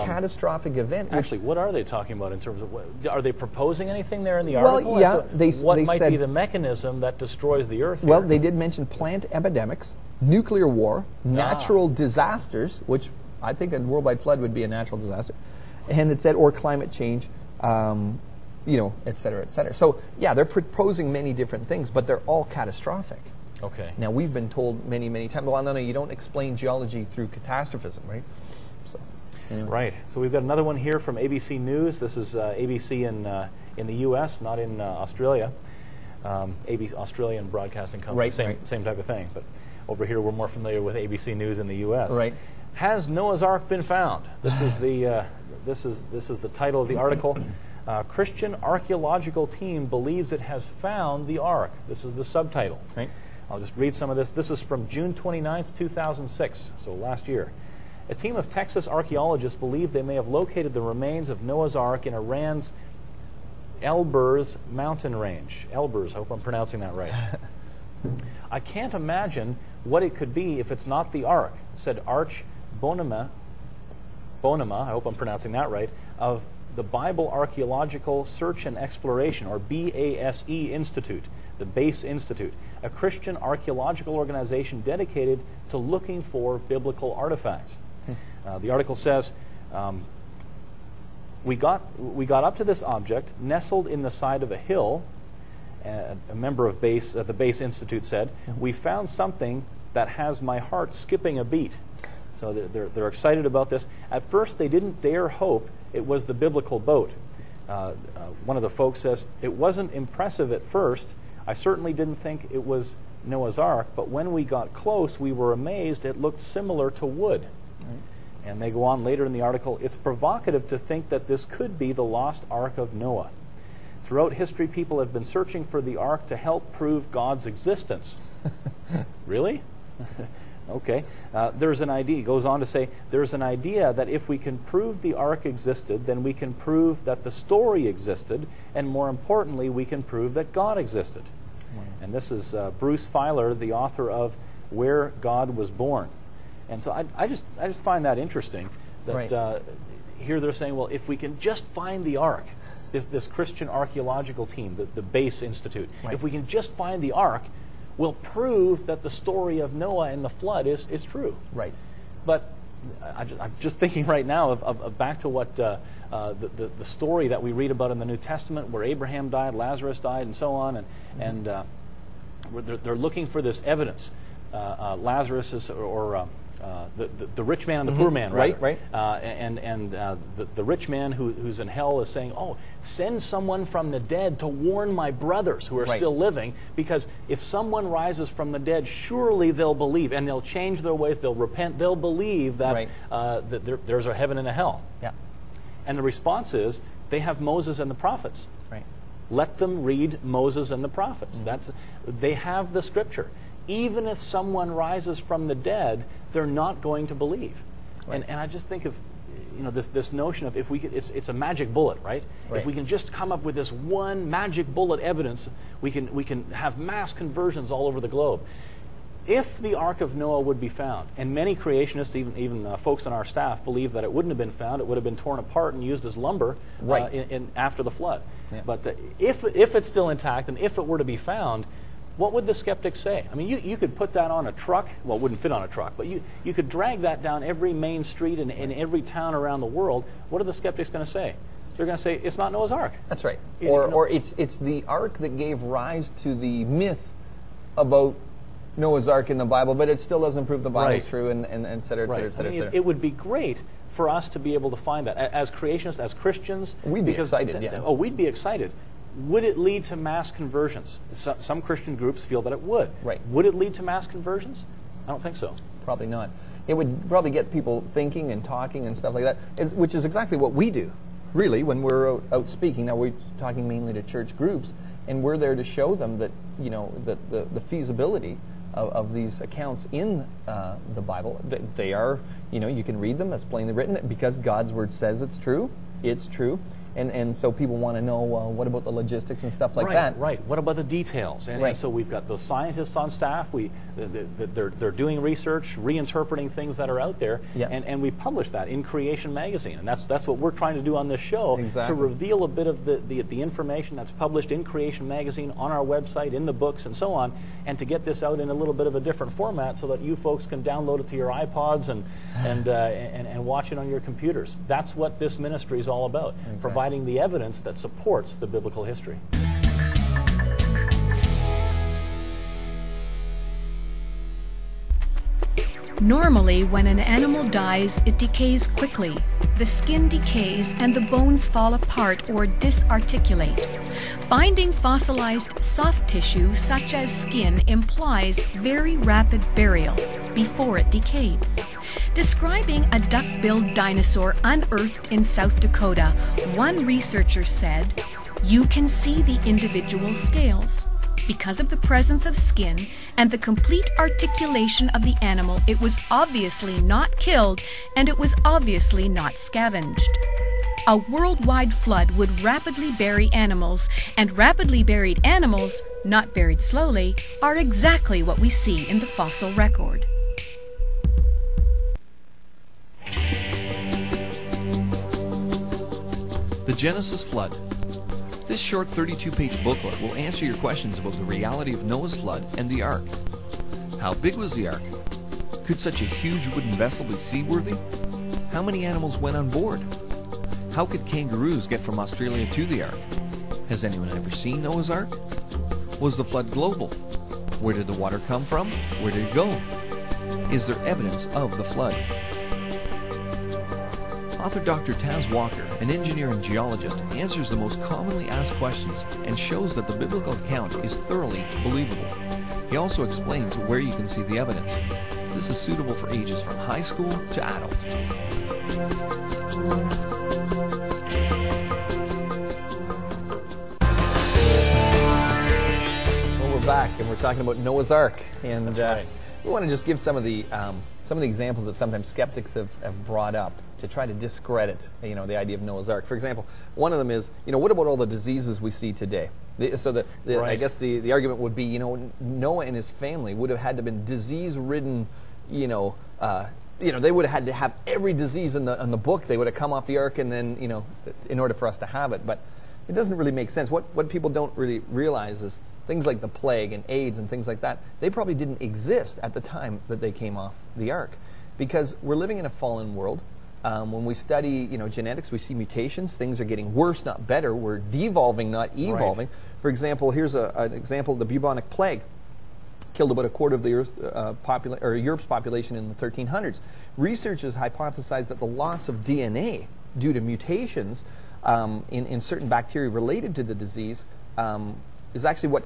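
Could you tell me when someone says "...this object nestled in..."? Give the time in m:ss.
1:32.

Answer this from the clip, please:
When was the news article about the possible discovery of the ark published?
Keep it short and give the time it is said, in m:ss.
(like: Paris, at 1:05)
June 29, 2006, at 0:54.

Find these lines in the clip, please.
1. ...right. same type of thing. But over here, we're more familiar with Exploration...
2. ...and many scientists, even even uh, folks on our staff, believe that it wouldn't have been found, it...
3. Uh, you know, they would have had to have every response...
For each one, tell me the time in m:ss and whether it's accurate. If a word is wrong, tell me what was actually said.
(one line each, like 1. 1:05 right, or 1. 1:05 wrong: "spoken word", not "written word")
1. 0:38 wrong: "ABC", not "Exploration"
2. 3:41 wrong: "creationists", not "scientists"
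3. 7:26 wrong: "disease", not "response".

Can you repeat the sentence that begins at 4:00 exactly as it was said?
What are the skeptics going to say?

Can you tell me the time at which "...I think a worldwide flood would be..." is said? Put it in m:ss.
0:13.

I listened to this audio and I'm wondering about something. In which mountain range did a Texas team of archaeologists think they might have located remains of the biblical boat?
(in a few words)
Elburz mountain range.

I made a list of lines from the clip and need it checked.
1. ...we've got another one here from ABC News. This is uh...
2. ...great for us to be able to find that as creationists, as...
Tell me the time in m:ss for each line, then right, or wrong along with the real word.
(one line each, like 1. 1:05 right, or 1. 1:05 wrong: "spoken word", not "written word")
1. 0:30 right
2. 4:13 right.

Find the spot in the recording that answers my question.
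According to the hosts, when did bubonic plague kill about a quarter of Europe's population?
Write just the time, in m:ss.
7:55.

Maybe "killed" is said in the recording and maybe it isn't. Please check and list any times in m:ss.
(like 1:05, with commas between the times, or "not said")
5:57, 7:52.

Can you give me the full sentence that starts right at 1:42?
So they're, they're excited about this.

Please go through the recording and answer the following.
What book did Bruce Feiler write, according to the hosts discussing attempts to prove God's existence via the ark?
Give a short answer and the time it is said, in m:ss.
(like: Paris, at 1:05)
Where God Was Born, at 2:24.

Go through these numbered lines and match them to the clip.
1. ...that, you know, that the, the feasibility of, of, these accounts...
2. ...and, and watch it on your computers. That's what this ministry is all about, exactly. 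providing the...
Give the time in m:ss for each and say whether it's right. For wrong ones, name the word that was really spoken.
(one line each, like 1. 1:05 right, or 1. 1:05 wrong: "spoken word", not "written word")
1. 4:36 right
2. 5:12 right.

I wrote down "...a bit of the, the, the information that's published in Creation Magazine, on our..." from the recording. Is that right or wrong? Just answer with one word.
right.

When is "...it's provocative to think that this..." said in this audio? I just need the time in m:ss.
1:59.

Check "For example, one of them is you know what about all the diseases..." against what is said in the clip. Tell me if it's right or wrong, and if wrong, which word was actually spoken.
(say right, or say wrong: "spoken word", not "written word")
right.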